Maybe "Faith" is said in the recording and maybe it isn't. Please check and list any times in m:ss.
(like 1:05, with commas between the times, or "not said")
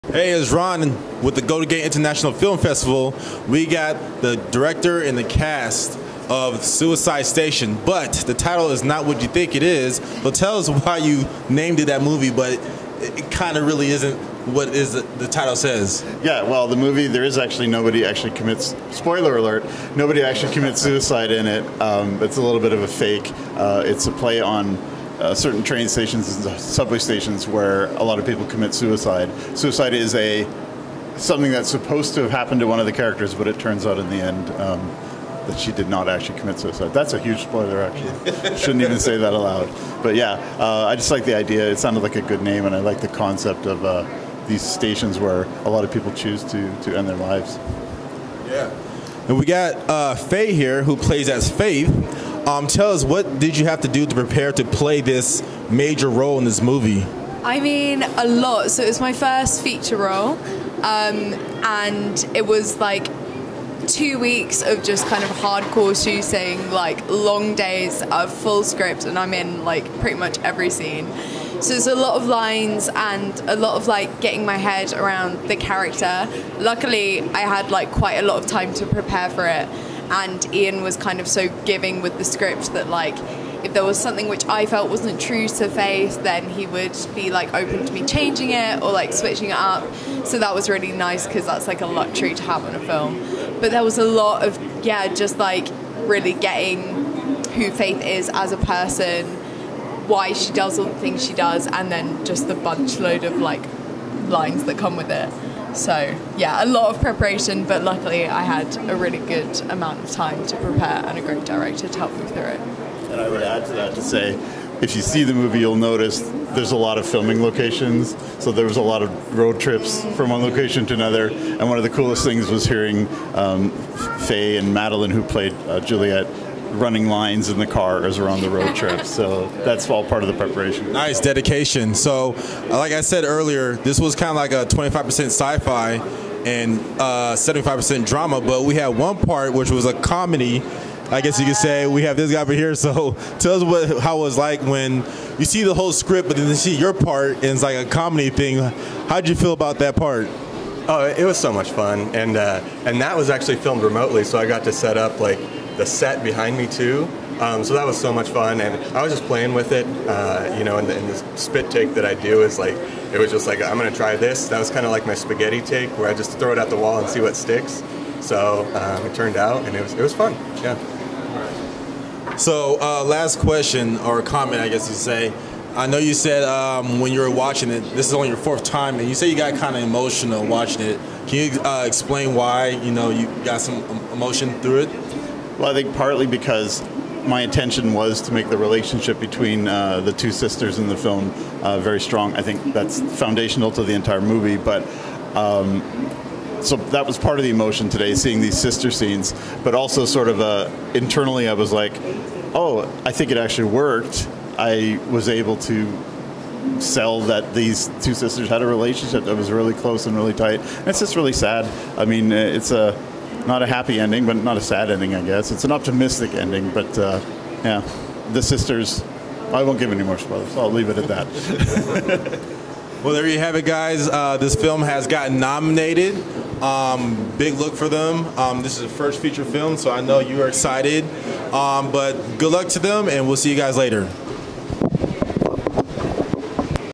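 0:51, 1:25, 1:37.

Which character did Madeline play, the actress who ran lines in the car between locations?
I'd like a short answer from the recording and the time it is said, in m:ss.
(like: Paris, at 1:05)
Juliet, at 2:05.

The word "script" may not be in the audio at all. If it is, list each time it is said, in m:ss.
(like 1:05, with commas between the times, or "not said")
1:08, 1:22, 2:25.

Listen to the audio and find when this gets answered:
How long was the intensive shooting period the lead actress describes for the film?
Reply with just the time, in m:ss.
1:03.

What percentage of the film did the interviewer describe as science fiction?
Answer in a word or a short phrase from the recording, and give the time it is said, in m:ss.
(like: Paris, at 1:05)
25%, at 2:14.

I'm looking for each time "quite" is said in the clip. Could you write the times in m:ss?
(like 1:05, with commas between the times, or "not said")
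1:17.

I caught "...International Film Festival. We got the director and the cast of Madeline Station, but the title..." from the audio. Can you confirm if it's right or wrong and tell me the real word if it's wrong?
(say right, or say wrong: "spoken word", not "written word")
wrong: "Suicide", not "Madeline".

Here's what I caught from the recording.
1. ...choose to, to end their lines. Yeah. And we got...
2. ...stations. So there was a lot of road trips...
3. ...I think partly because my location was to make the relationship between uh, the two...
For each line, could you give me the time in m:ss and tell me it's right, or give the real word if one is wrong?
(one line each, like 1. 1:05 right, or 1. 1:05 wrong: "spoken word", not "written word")
1. 0:46 wrong: "lives", not "lines"
2. 1:57 wrong: "locations", not "stations"
3. 3:05 wrong: "intention", not "location".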